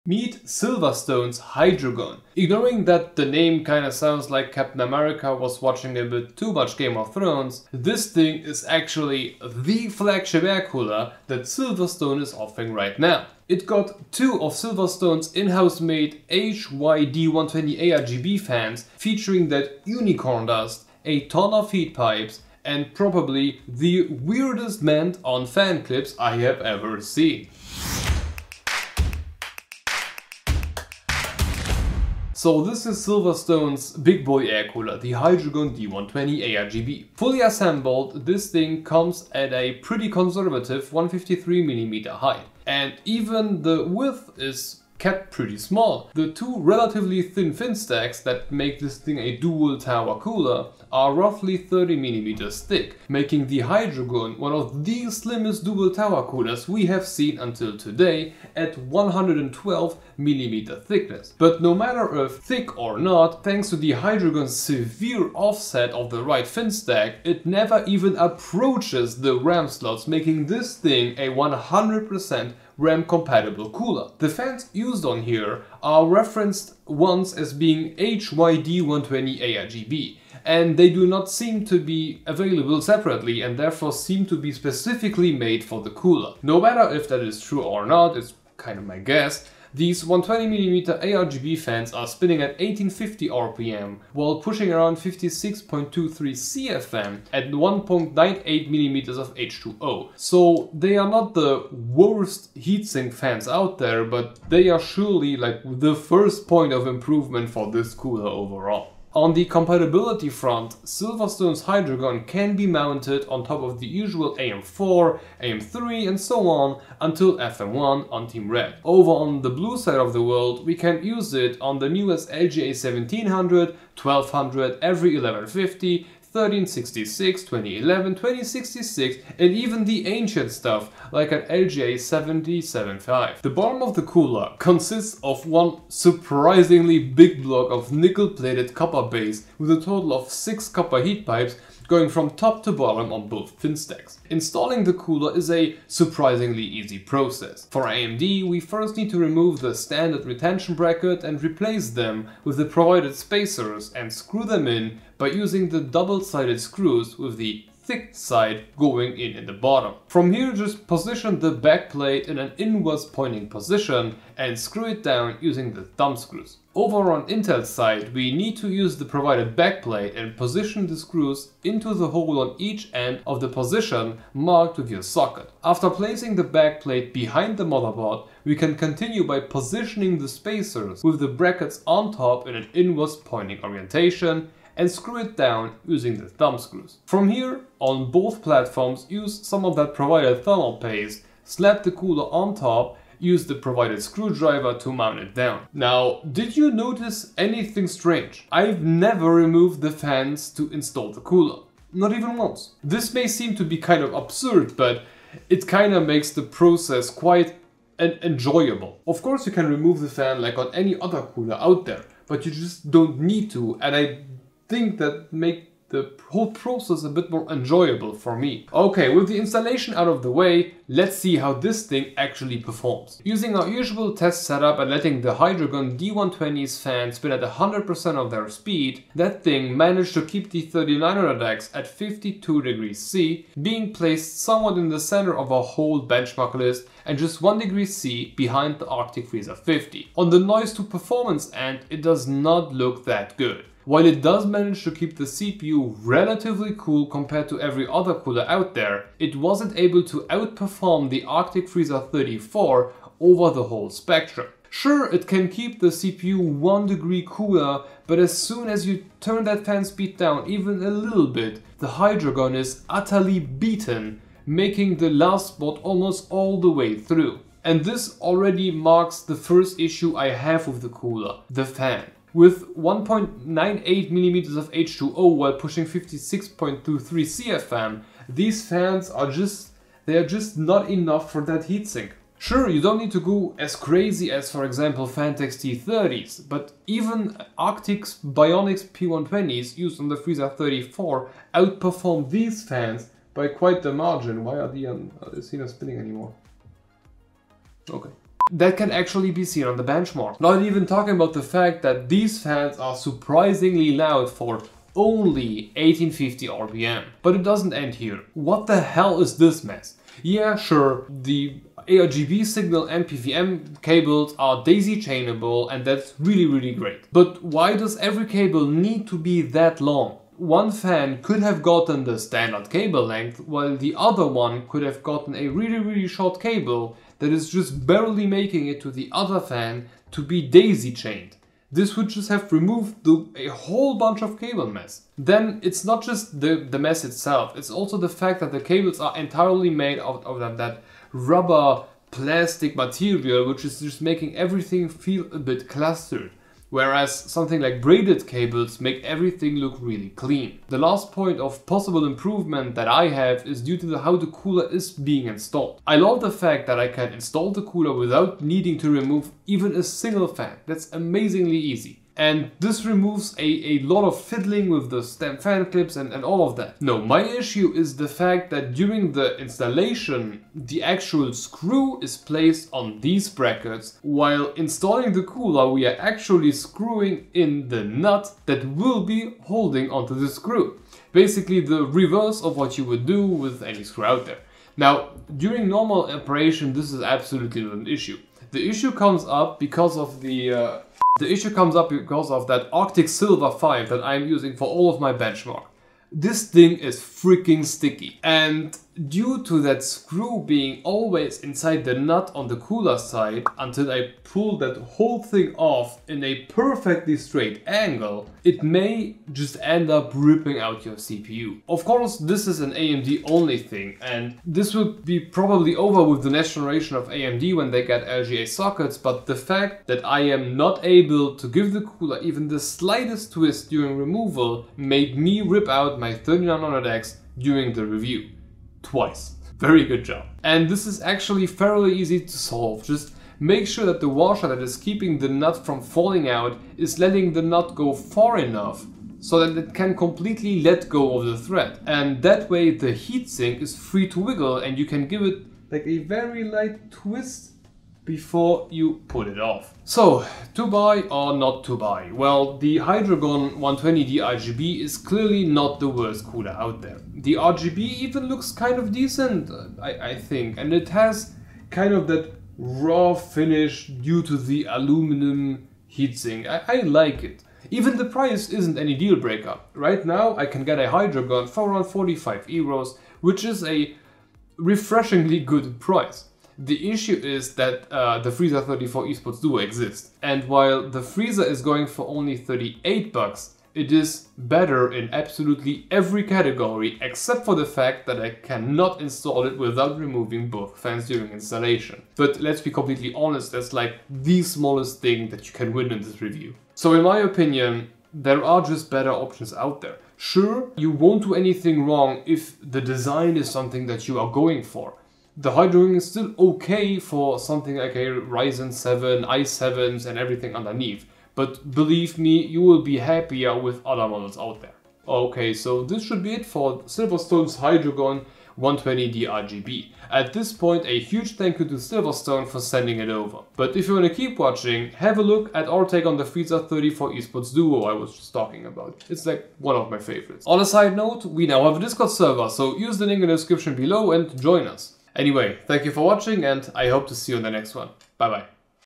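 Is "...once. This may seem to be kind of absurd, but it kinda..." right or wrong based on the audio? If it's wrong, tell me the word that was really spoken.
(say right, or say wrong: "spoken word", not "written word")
right.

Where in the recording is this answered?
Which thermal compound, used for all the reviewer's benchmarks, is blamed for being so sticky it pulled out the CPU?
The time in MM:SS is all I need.
06:32.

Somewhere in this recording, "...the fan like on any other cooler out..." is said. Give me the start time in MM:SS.
03:29.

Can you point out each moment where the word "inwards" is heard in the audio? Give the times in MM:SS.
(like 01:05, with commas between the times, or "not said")
02:42, 03:02.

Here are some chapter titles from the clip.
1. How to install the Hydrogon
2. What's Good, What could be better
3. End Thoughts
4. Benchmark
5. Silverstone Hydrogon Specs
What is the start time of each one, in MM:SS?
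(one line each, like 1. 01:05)
1. 02:25
2. 04:25
3. 07:30
4. 03:40
5. 00:35.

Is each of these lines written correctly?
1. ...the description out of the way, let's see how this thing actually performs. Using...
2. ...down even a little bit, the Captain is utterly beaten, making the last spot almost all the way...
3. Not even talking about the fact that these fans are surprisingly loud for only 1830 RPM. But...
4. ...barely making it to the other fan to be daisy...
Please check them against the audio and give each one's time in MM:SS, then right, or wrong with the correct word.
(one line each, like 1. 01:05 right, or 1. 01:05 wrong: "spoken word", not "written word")
1. 03:39 wrong: "installation", not "description"
2. 04:20 wrong: "Hydrogon", not "Captain"
3. 05:00 wrong: "1850", not "1830"
4. 05:27 right.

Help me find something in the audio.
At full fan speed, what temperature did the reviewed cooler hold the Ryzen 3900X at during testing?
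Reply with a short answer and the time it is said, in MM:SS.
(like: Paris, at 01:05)
52 degrees C, at 03:51.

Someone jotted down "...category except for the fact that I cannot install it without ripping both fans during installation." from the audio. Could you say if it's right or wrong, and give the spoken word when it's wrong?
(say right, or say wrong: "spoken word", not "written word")
wrong: "removing", not "ripping".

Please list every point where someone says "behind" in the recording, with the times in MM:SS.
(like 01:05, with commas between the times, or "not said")
02:57, 03:58.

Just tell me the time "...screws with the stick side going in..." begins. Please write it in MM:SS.
02:36.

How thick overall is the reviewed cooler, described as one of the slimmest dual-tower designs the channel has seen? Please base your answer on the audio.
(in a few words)
112mm.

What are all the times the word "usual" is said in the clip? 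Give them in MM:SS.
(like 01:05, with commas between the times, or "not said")
01:53, 03:43.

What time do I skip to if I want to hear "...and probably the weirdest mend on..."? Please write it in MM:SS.
00:22.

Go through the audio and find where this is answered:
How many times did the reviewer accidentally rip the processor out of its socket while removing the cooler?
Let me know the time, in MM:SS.
07:08.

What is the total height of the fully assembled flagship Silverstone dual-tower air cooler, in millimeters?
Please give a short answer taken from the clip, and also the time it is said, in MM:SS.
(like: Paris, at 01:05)
153mm, at 00:40.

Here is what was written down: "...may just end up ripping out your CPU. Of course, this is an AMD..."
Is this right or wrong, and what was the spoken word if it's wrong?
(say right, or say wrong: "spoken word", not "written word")
right.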